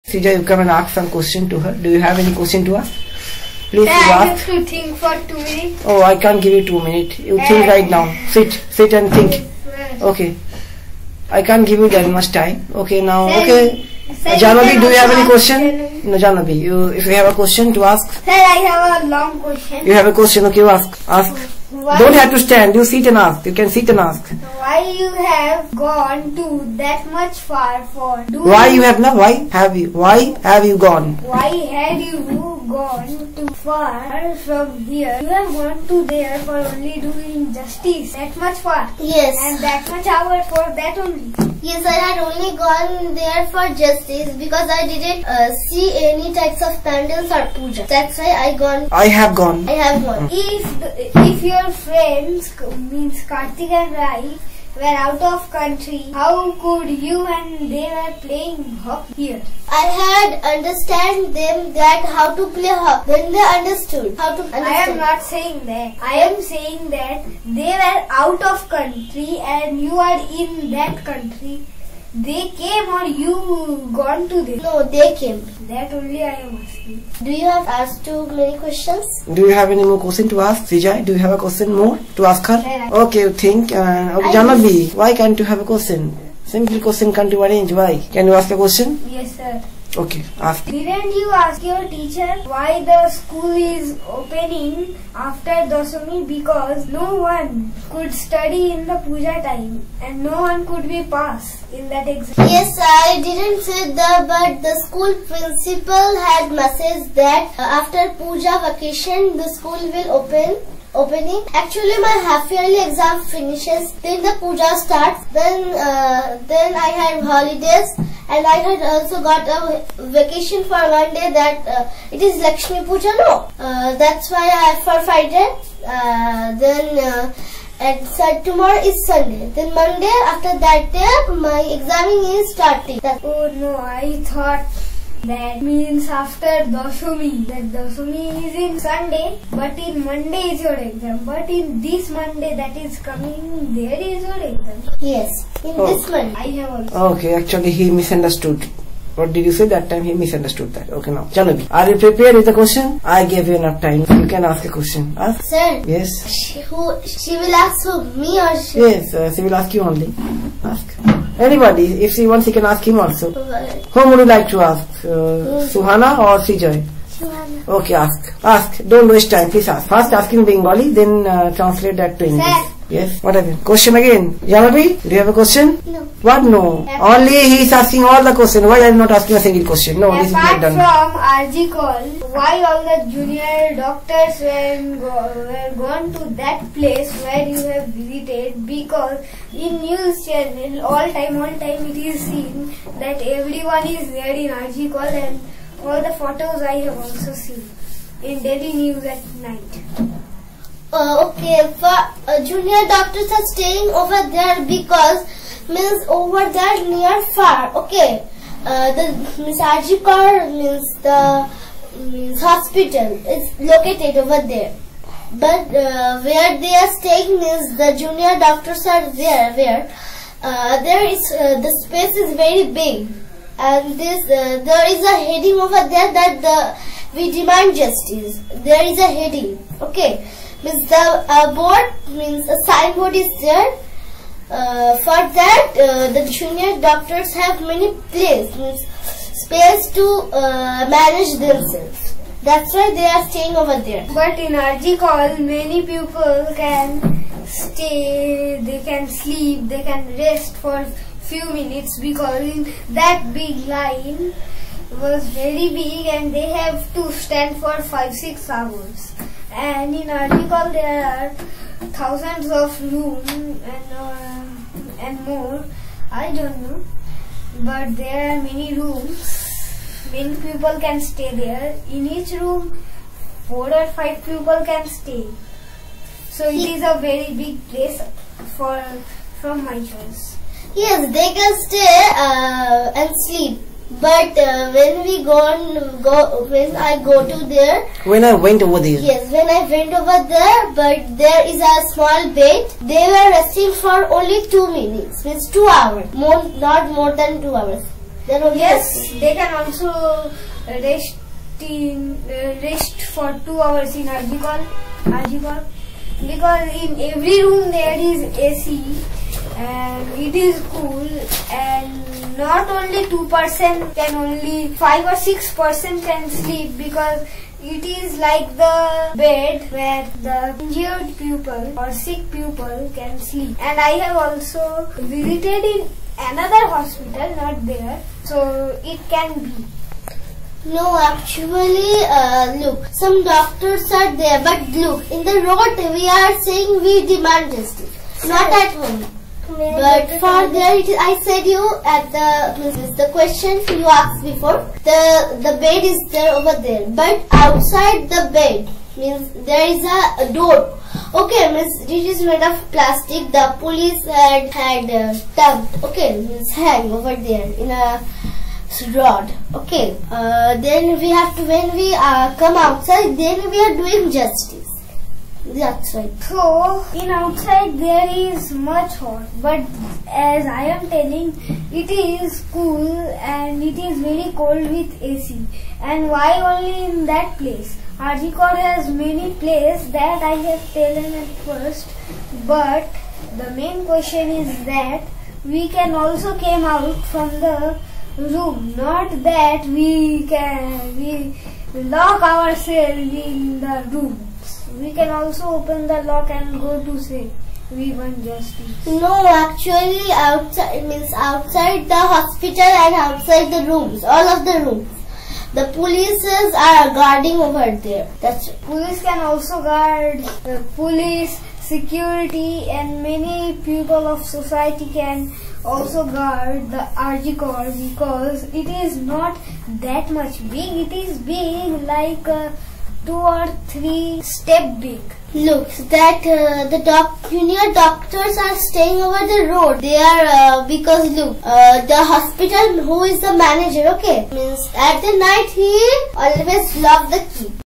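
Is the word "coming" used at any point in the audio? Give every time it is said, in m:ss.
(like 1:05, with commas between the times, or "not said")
2:22.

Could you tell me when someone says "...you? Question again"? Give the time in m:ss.
2:53.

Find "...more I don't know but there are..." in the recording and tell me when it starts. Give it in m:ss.
4:25.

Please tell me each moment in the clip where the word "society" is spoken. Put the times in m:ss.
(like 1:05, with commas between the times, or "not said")
6:54.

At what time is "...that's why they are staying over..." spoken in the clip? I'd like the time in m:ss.
4:02.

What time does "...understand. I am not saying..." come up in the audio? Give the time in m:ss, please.
1:04.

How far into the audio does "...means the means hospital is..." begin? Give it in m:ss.
3:30.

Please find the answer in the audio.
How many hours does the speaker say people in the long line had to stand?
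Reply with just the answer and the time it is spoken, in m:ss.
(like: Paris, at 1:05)
5 6 hours, at 4:17.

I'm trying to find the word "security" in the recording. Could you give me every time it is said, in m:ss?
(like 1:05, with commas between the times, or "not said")
6:51.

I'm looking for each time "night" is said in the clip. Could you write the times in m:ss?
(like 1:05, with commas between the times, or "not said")
3:19, 7:15.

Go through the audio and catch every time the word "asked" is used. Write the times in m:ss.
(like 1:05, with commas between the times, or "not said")
1:17, 5:43.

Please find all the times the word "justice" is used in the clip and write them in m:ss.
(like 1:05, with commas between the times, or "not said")
0:37, 0:43, 3:47, 5:37, 6:04, 6:38.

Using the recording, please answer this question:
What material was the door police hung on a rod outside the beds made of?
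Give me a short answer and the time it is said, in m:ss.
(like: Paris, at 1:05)
plastic, at 5:52.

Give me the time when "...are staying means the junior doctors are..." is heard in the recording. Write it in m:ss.
3:36.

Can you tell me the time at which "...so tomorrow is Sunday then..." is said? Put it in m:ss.
2:08.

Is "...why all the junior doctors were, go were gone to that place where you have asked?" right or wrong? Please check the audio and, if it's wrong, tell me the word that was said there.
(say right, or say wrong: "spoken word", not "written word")
wrong: "visited", not "asked".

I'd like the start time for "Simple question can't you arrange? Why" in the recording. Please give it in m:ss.
1:26.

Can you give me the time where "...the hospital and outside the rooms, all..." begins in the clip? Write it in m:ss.
6:41.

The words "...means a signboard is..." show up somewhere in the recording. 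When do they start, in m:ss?
3:52.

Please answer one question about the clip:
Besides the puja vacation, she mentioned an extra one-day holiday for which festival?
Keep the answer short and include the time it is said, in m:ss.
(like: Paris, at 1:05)
Lakshmi Puja, at 2:02.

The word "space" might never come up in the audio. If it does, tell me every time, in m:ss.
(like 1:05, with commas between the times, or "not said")
3:41, 3:59.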